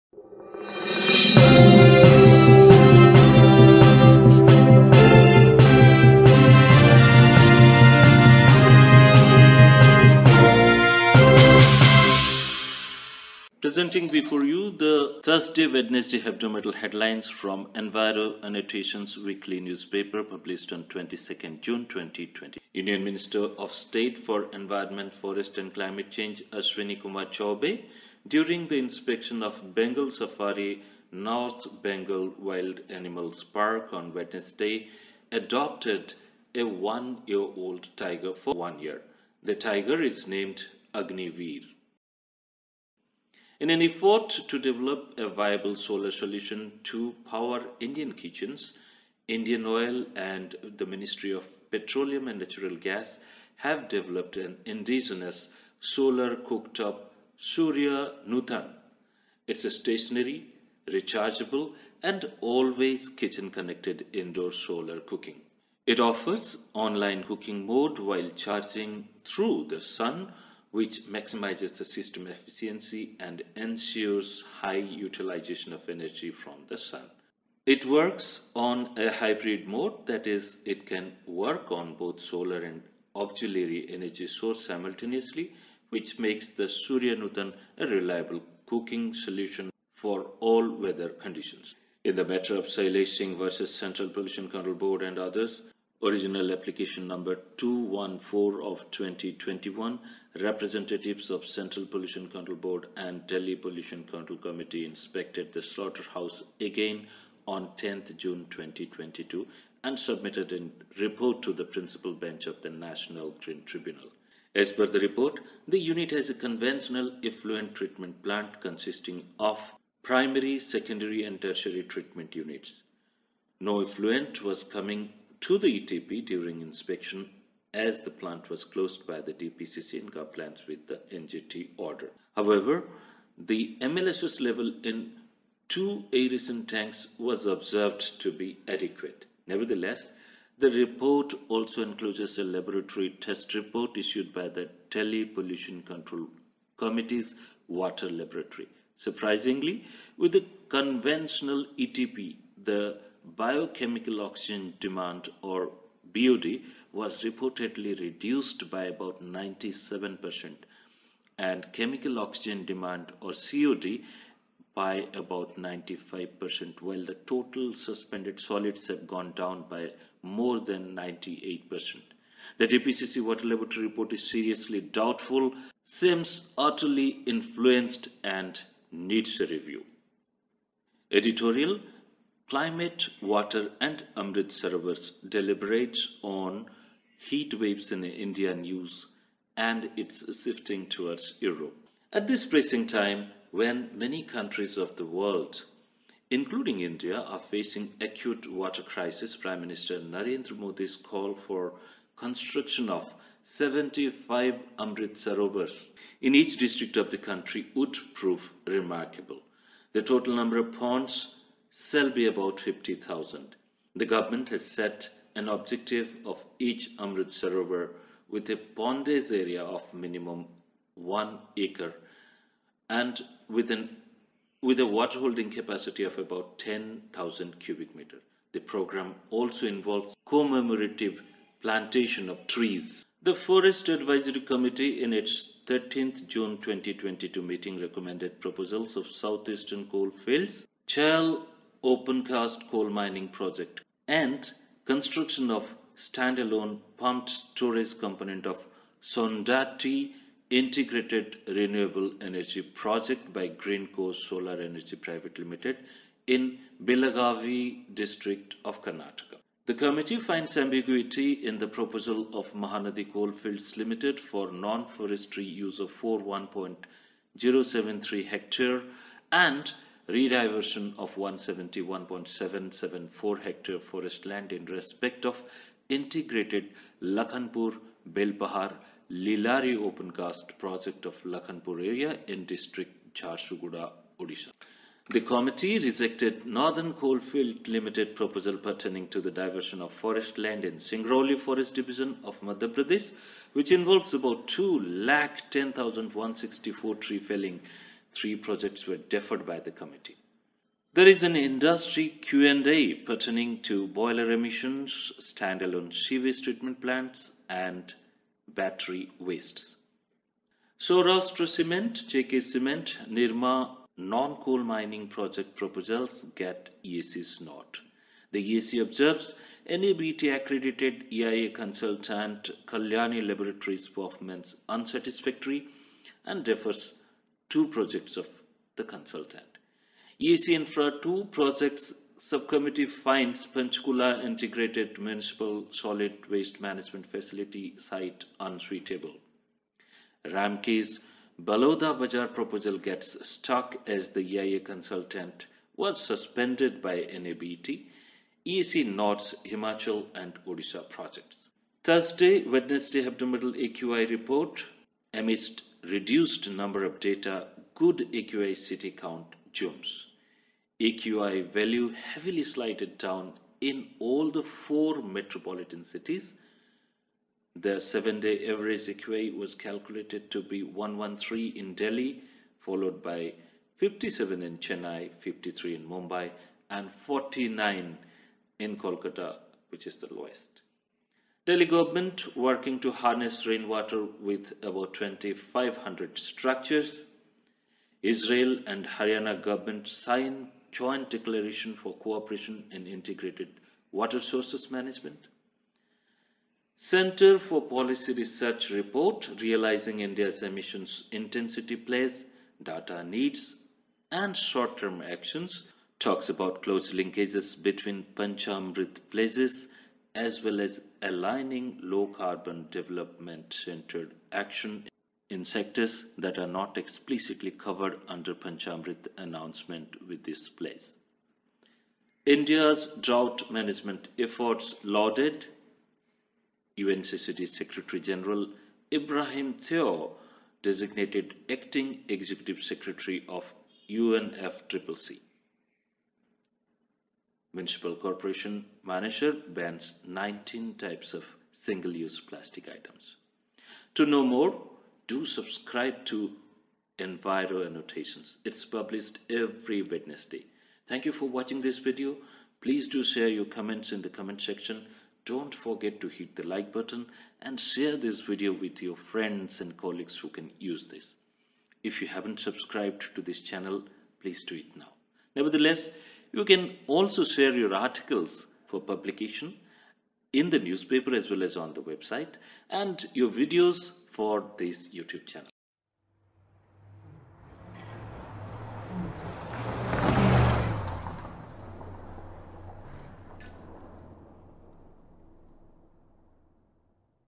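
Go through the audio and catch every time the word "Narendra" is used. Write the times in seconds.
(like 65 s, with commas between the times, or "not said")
199 s.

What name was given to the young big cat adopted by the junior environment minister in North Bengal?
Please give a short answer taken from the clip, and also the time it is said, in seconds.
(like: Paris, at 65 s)
Agniveer, at 40 s.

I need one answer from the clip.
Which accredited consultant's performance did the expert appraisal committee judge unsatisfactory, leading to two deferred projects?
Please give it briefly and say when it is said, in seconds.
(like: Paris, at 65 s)
Kalyani Laboratories, at 322 s.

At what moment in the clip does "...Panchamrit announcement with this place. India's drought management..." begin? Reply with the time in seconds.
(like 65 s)
418 s.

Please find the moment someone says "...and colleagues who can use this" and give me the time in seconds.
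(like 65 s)
459 s.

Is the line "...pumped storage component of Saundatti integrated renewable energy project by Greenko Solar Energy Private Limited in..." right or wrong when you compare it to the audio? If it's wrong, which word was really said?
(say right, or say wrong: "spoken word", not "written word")
right.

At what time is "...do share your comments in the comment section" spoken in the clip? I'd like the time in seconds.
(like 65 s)
452 s.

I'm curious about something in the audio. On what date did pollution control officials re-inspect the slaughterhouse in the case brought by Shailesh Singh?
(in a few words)
10 June 2022.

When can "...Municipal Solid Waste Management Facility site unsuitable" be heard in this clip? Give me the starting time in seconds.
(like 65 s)
334 s.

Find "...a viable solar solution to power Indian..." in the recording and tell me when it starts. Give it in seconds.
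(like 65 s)
45 s.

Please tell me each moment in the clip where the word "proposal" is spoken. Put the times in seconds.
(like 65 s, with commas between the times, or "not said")
238 s, 261 s, 288 s, 315 s, 342 s.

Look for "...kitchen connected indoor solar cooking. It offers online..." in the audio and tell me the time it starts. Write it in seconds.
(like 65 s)
63 s.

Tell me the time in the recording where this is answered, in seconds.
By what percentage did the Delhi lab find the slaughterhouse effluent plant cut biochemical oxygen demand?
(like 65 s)
159 s.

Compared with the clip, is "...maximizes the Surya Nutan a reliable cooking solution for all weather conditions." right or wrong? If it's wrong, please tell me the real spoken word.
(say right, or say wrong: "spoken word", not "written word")
wrong: "makes", not "maximizes".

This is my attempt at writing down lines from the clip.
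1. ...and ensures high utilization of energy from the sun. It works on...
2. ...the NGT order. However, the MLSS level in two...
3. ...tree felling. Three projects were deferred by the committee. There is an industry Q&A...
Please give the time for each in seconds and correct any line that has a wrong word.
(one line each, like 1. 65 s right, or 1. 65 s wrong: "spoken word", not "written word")
1. 73 s right
2. 130 s right
3. 296 s right.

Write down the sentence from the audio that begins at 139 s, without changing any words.
Nevertheless, the report also includes a laboratory test report issued by the Delhi Pollution Control Committee's Water Laboratory.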